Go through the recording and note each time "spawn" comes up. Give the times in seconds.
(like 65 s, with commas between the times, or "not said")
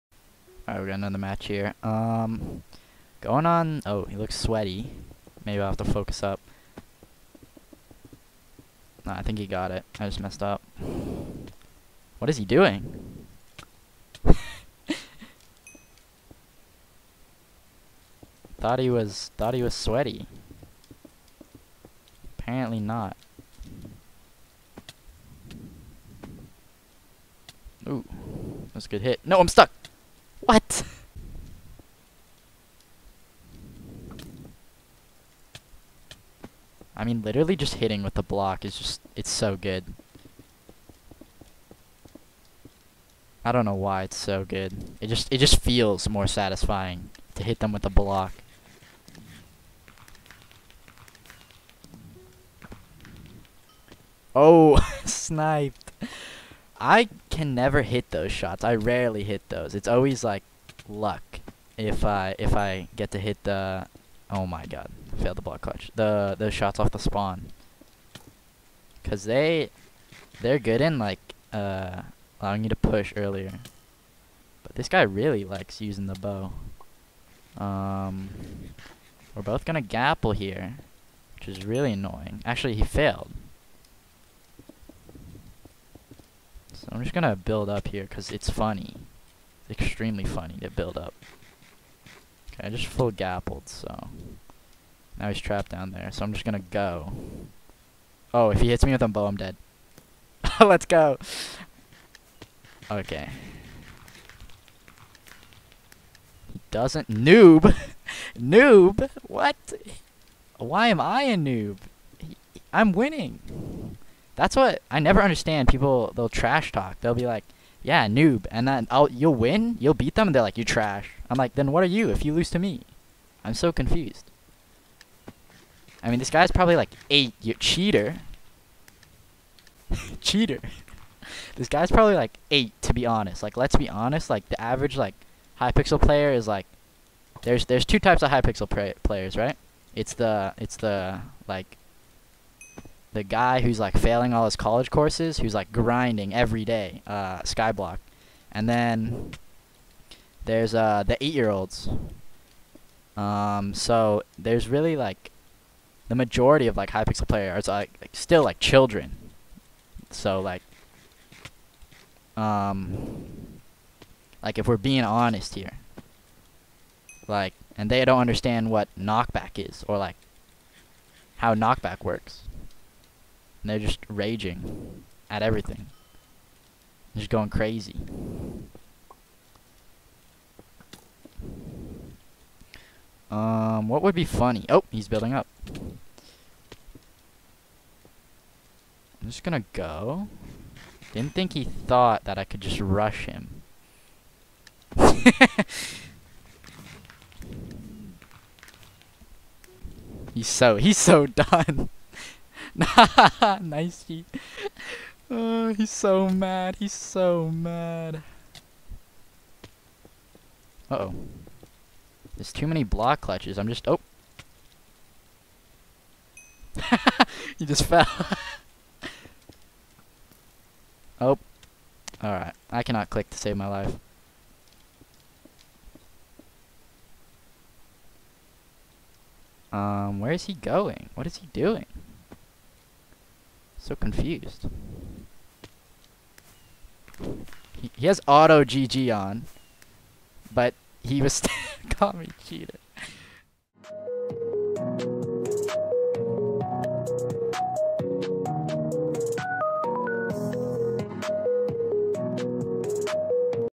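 66 s.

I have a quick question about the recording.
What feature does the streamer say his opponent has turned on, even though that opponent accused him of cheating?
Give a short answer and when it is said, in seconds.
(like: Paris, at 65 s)
auto GG, at 238 s.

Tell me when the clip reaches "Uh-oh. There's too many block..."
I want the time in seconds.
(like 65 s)
210 s.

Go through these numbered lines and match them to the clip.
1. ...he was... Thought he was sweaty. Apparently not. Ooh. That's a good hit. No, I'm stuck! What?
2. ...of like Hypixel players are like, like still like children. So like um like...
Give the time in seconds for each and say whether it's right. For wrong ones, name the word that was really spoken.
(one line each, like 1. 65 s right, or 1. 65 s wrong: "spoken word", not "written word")
1. 18 s right
2. 156 s right.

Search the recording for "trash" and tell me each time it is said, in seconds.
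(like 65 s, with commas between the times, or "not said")
116 s, 120 s.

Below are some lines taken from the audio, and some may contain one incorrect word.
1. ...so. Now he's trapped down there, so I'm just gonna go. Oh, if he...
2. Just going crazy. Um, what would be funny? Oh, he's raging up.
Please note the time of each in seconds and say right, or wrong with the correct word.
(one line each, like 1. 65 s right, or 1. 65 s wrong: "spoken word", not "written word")
1. 93 s right
2. 177 s wrong: "building", not "raging".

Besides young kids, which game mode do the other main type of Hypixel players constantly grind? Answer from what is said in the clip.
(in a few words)
Skyblock.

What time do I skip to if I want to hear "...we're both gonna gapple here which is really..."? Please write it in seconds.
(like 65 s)
79 s.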